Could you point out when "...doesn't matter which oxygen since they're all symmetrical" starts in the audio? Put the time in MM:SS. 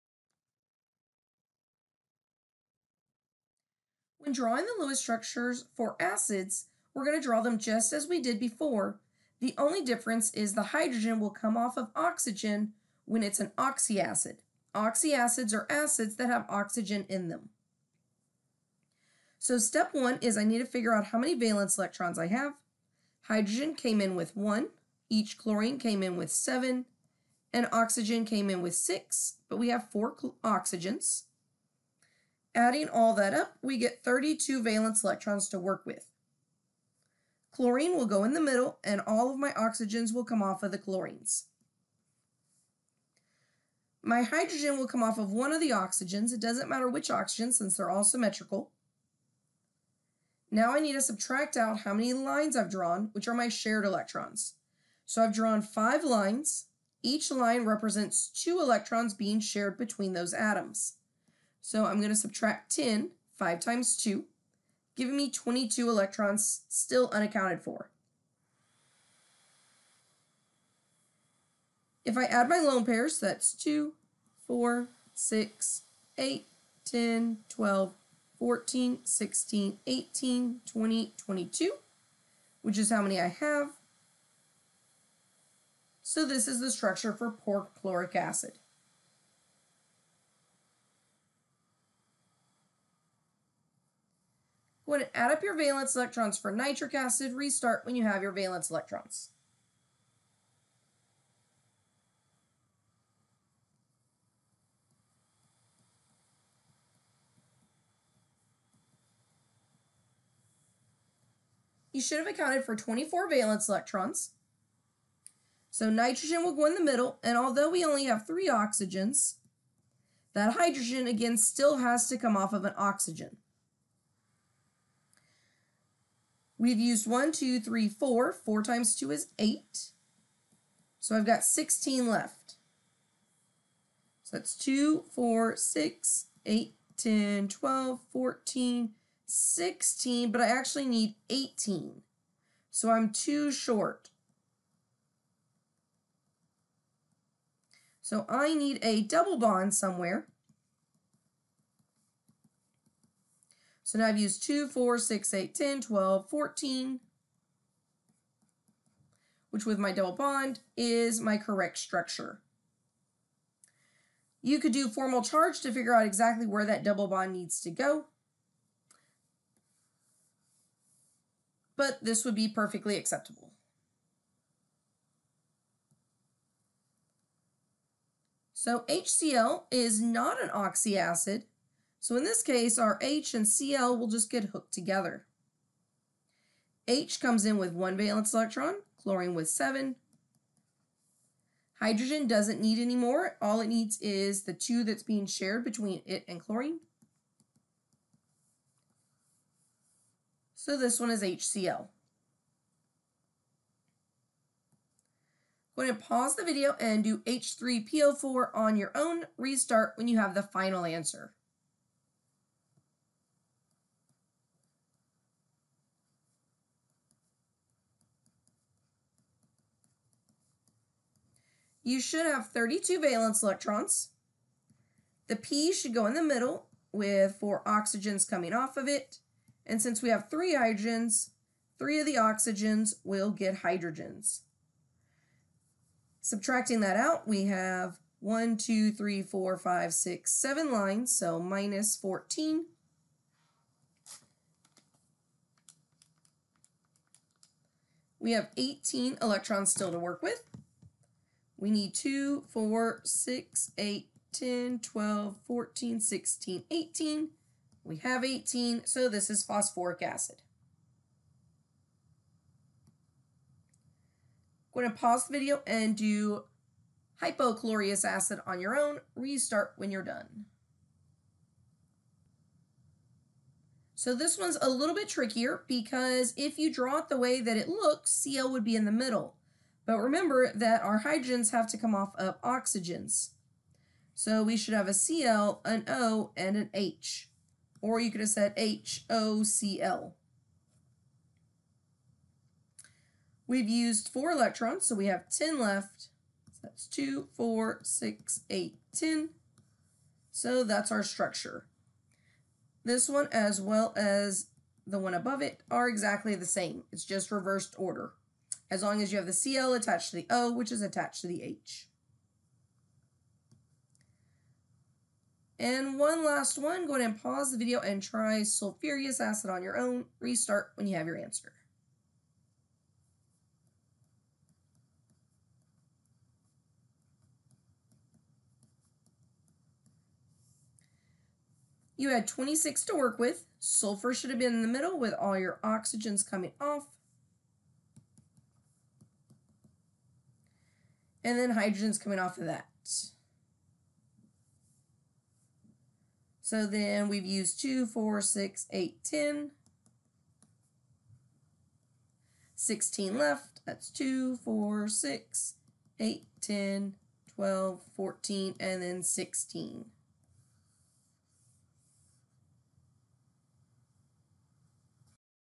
00:46.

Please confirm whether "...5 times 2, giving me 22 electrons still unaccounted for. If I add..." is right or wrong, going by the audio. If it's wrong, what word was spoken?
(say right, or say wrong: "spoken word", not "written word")
right.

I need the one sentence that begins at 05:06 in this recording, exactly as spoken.
It's just reversed order as long as you have the CL attached to the O, which is attached to the H.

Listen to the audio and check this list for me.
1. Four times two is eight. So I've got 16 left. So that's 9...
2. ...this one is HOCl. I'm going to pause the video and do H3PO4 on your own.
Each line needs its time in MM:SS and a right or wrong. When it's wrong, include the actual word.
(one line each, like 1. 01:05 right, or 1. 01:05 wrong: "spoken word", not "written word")
1. 02:08 wrong: "8", not "9"
2. 03:20 wrong: "HCl", not "HOCl".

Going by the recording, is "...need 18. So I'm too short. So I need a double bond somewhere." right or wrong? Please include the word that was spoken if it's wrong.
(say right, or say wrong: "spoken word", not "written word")
right.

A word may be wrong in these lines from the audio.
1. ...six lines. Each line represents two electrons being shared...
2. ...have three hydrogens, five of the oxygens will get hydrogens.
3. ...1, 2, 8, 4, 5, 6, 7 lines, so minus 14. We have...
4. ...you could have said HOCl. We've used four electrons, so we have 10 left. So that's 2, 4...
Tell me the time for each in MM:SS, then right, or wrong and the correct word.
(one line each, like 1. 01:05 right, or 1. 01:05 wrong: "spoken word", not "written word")
1. 00:55 wrong: "five", not "six"
2. 03:50 wrong: "three", not "five"
3. 03:58 wrong: "3", not "8"
4. 04:47 right.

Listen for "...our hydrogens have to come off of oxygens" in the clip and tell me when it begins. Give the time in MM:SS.
04:40.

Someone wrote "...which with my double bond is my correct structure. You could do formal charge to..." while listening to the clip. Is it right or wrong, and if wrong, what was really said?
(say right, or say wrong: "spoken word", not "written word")
right.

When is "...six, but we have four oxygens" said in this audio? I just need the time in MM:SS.
00:28.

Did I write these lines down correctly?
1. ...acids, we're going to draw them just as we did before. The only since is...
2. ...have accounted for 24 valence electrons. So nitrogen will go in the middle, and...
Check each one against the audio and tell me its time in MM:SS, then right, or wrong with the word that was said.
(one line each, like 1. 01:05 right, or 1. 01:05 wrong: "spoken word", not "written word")
1. 00:05 wrong: "difference", not "since"
2. 01:52 right.